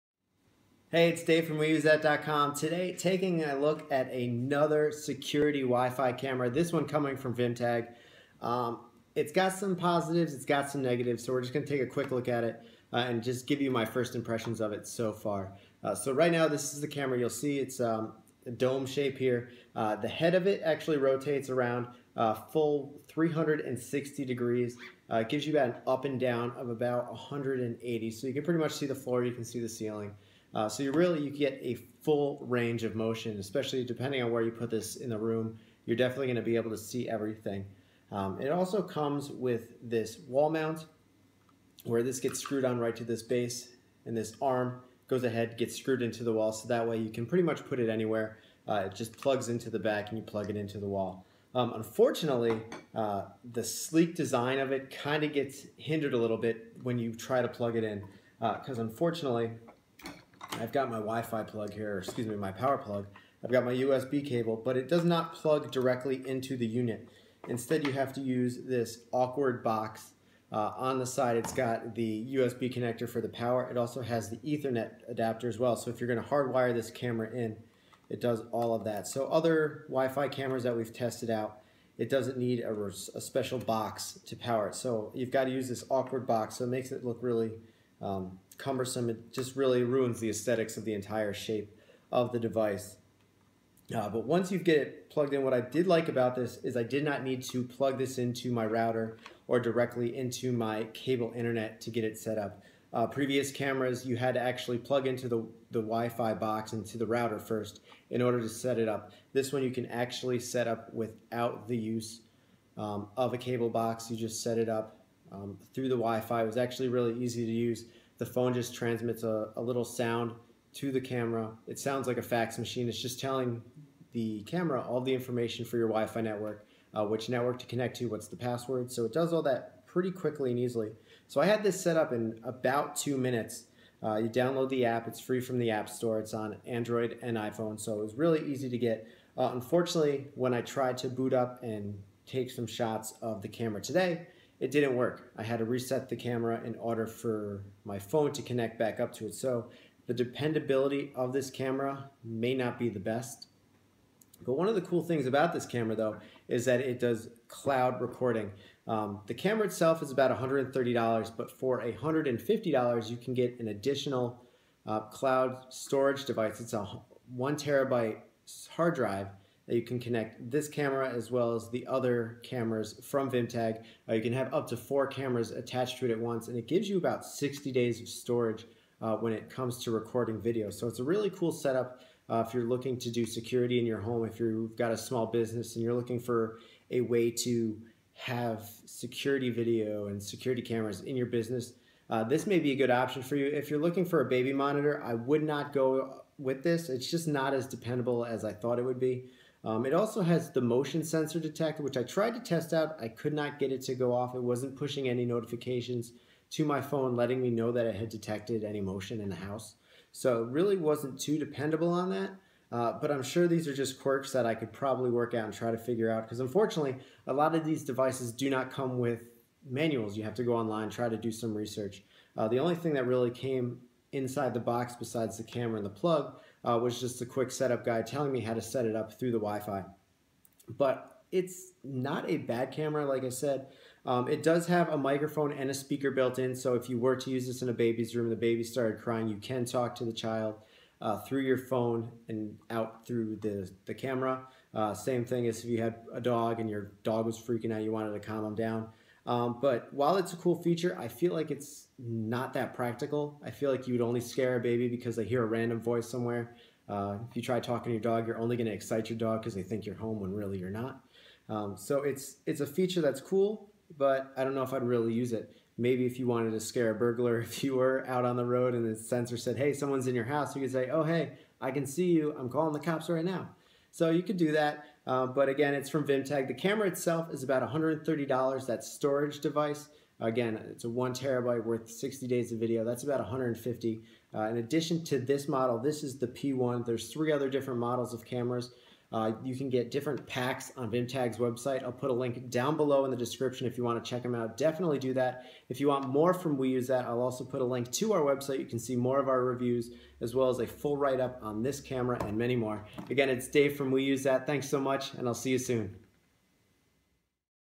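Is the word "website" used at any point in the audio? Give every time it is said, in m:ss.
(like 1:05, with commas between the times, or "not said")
4:51, 4:58.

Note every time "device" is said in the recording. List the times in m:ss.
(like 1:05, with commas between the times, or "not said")
1:32, 2:46, 3:37, 4:39.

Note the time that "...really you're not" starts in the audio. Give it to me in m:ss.
4:20.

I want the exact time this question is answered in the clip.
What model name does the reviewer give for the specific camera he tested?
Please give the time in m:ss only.
4:46.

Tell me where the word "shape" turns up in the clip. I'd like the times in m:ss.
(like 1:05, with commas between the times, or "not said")
0:18, 1:31.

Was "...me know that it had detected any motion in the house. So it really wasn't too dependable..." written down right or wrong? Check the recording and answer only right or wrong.
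right.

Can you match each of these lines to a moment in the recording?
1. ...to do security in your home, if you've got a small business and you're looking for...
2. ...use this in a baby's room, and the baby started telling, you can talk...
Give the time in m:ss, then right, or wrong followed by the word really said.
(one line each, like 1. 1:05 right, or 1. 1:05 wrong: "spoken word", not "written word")
1. 3:02 right
2. 3:57 wrong: "crying", not "telling".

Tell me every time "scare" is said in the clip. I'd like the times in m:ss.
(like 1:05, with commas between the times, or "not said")
4:14, 4:26.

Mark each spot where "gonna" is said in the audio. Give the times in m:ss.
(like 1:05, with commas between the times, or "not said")
0:36, 1:16.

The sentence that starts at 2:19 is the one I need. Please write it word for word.
Uh, unfortunately, when I tried to boot up and take some shots of the camera today, it didn't work.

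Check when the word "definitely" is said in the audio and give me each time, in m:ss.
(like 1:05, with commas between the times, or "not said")
0:35, 4:54.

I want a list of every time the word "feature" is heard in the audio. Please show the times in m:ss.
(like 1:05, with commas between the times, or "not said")
4:10, 4:22.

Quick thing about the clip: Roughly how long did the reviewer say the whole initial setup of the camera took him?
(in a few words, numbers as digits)
2 minutes.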